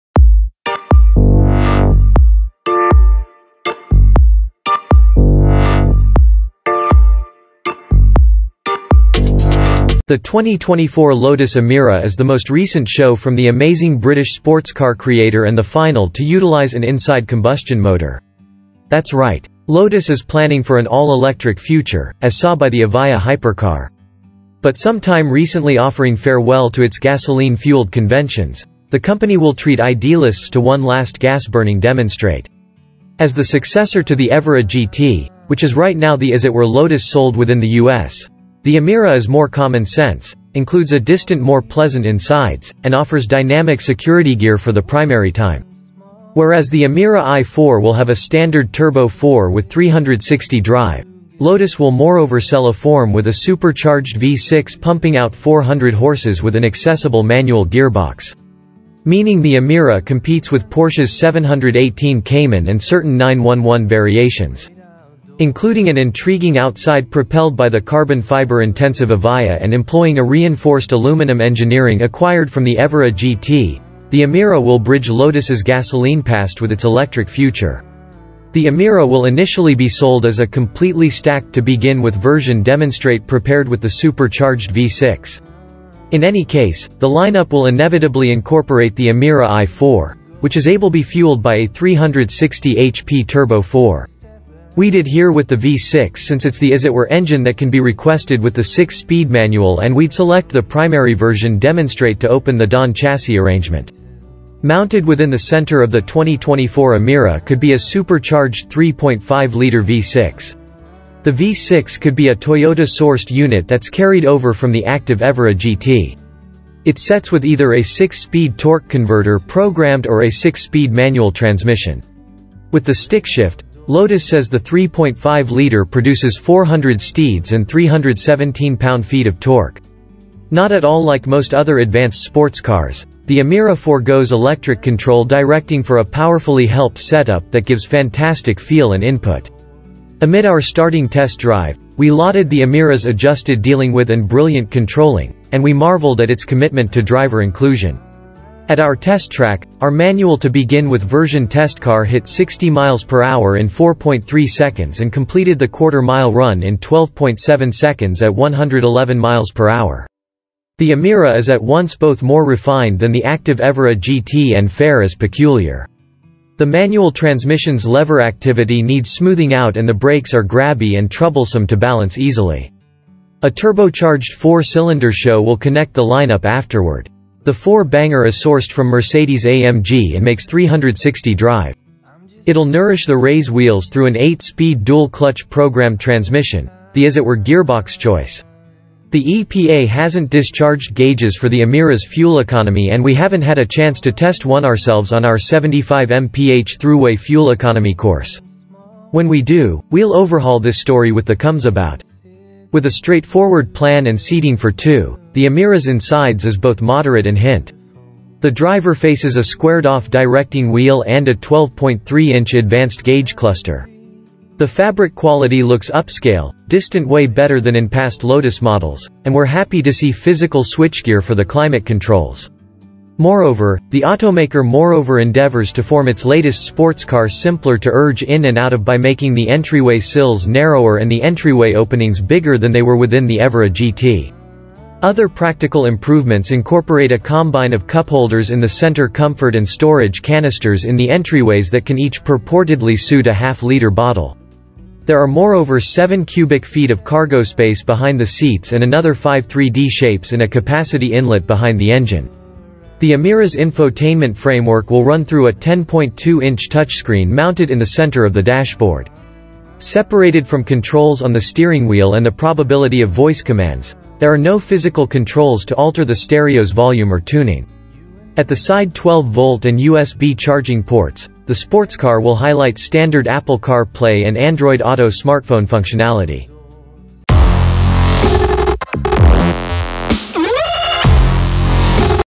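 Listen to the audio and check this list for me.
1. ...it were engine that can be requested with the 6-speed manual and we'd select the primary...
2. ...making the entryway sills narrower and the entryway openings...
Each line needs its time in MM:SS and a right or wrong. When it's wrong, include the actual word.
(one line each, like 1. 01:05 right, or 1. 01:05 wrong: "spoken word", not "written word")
1. 01:36 right
2. 03:48 right.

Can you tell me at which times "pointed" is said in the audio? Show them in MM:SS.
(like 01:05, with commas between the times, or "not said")
not said.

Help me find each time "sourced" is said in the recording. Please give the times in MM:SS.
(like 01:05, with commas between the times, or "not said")
01:52, 02:58.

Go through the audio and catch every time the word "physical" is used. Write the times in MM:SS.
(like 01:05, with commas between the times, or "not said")
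03:40, 04:24.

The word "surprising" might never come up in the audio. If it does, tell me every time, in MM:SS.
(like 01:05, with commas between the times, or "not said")
not said.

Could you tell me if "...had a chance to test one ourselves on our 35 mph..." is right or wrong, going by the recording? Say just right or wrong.
wrong.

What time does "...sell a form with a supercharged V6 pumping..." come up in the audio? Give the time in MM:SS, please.
00:52.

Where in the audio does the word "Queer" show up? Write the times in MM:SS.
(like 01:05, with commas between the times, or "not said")
not said.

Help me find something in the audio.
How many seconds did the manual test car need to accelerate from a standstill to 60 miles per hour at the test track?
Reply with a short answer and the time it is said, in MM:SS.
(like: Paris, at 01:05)
4.3 seconds, at 02:33.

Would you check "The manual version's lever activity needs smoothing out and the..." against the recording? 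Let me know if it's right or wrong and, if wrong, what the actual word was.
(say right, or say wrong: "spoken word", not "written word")
wrong: "transmission", not "version".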